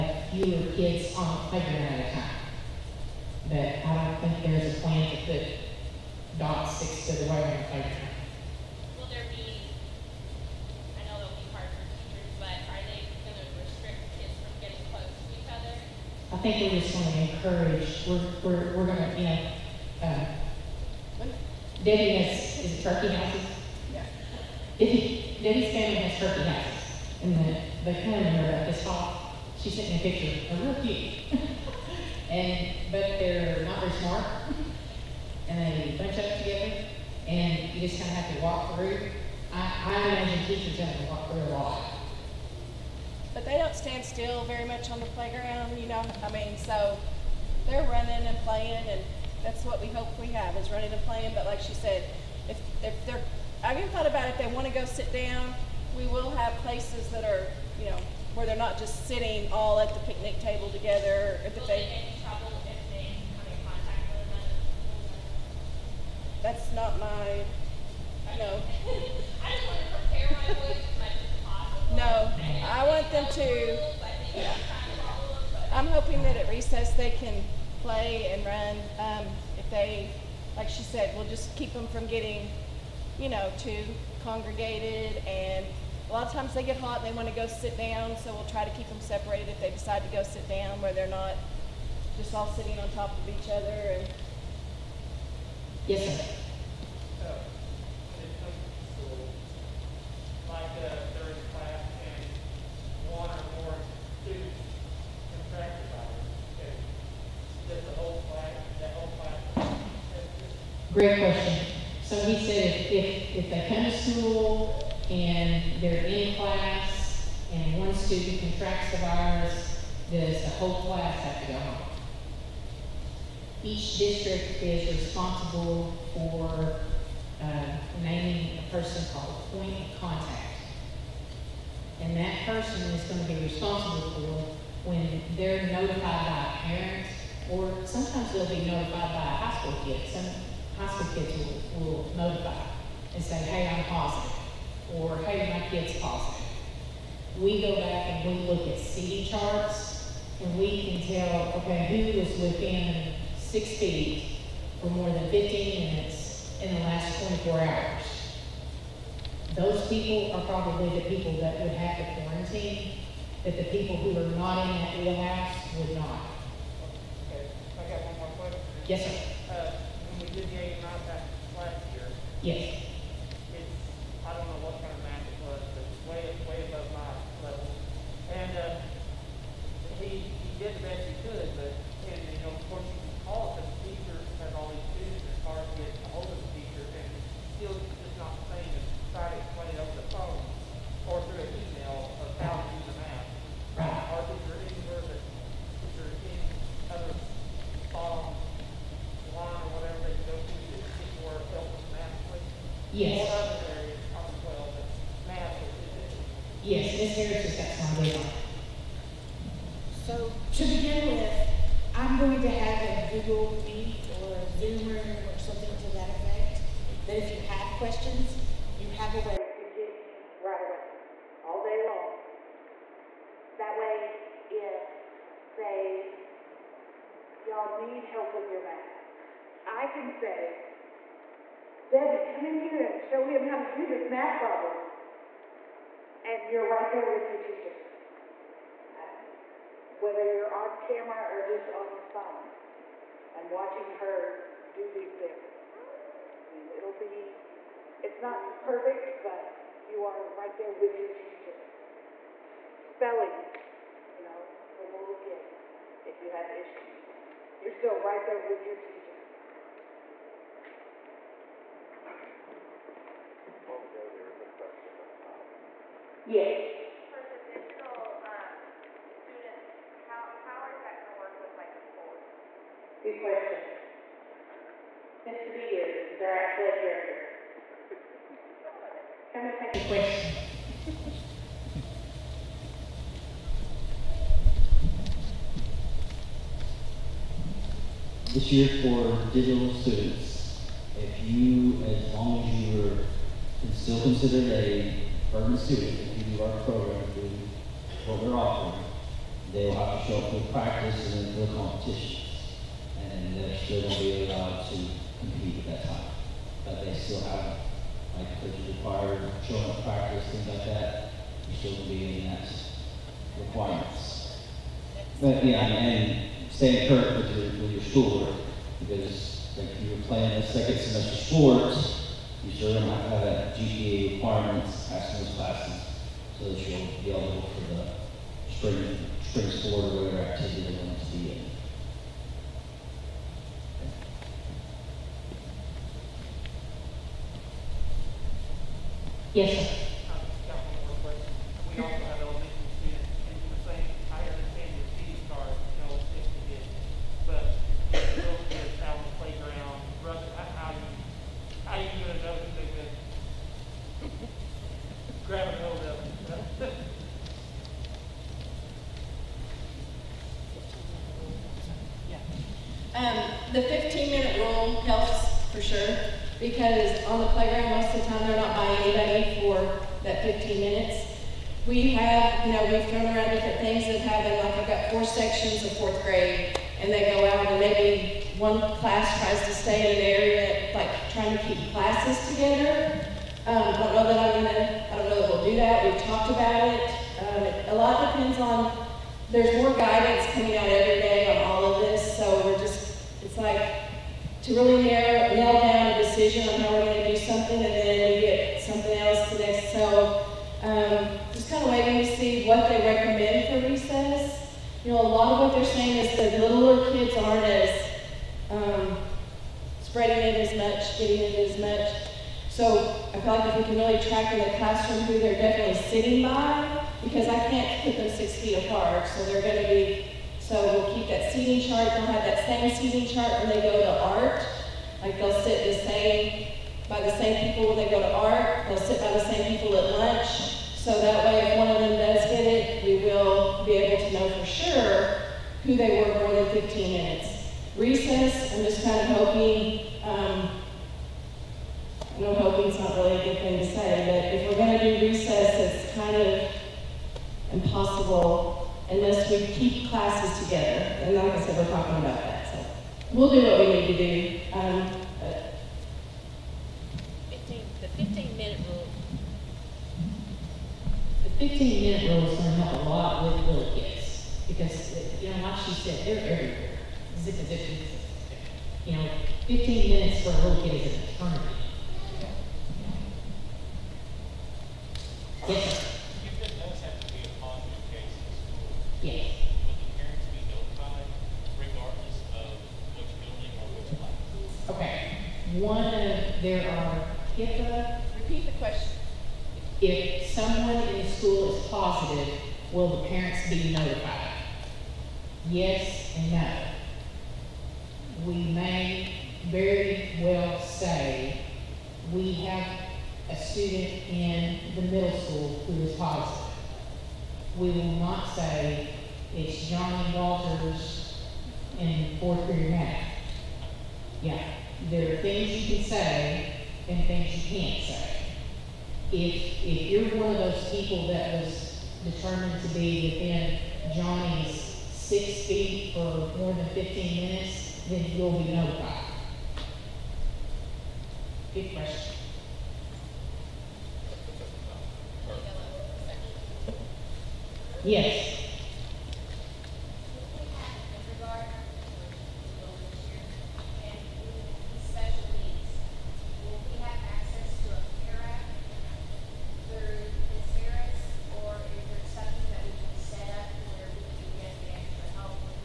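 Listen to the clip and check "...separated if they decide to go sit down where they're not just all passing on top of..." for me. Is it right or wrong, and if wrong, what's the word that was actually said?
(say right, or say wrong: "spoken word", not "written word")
wrong: "sitting", not "passing".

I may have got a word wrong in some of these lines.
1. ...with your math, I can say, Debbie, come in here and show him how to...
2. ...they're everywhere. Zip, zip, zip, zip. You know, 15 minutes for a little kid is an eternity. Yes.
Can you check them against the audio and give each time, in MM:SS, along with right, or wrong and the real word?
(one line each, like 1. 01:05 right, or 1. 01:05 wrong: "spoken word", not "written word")
1. 03:48 right
2. 07:46 right.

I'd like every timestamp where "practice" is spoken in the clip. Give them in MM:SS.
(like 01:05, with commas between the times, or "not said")
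05:00, 05:09.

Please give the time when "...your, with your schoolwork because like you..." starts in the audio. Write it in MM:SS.
05:17.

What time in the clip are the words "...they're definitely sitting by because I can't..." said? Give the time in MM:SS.
06:55.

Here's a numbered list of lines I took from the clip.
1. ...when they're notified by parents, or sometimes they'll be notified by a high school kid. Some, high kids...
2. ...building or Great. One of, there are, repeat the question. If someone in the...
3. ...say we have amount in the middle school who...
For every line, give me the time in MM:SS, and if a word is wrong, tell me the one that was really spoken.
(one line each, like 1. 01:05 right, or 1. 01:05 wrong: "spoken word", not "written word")
1. 02:14 right
2. 08:02 wrong: "Okay", not "Great"
3. 08:20 wrong: "student", not "amount".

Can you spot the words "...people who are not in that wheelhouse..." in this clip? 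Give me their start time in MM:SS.
02:43.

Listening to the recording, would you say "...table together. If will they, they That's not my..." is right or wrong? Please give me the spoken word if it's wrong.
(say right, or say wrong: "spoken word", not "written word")
right.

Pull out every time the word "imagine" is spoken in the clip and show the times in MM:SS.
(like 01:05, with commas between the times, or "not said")
00:40.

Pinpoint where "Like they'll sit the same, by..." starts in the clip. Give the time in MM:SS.
07:05.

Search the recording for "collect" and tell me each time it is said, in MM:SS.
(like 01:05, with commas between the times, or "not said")
not said.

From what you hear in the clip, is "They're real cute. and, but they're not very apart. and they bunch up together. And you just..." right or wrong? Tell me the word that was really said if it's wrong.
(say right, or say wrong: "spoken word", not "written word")
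wrong: "smart", not "apart".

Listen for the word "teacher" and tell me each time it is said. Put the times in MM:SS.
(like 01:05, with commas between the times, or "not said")
00:40, 03:57, 04:11, 04:18.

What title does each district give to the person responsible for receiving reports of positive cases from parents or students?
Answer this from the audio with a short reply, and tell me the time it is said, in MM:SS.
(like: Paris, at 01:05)
point of contact, at 02:09.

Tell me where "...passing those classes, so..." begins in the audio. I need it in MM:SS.
05:24.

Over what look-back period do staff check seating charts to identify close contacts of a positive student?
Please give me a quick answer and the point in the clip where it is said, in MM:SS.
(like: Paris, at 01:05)
24 hours, at 02:37.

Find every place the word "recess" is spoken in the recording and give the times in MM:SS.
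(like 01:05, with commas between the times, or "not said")
01:16, 07:17, 07:25.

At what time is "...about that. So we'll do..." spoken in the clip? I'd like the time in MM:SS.
07:31.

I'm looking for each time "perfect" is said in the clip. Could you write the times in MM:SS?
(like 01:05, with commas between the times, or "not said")
04:08.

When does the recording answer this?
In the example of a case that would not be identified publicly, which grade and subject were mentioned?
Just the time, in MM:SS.
08:32.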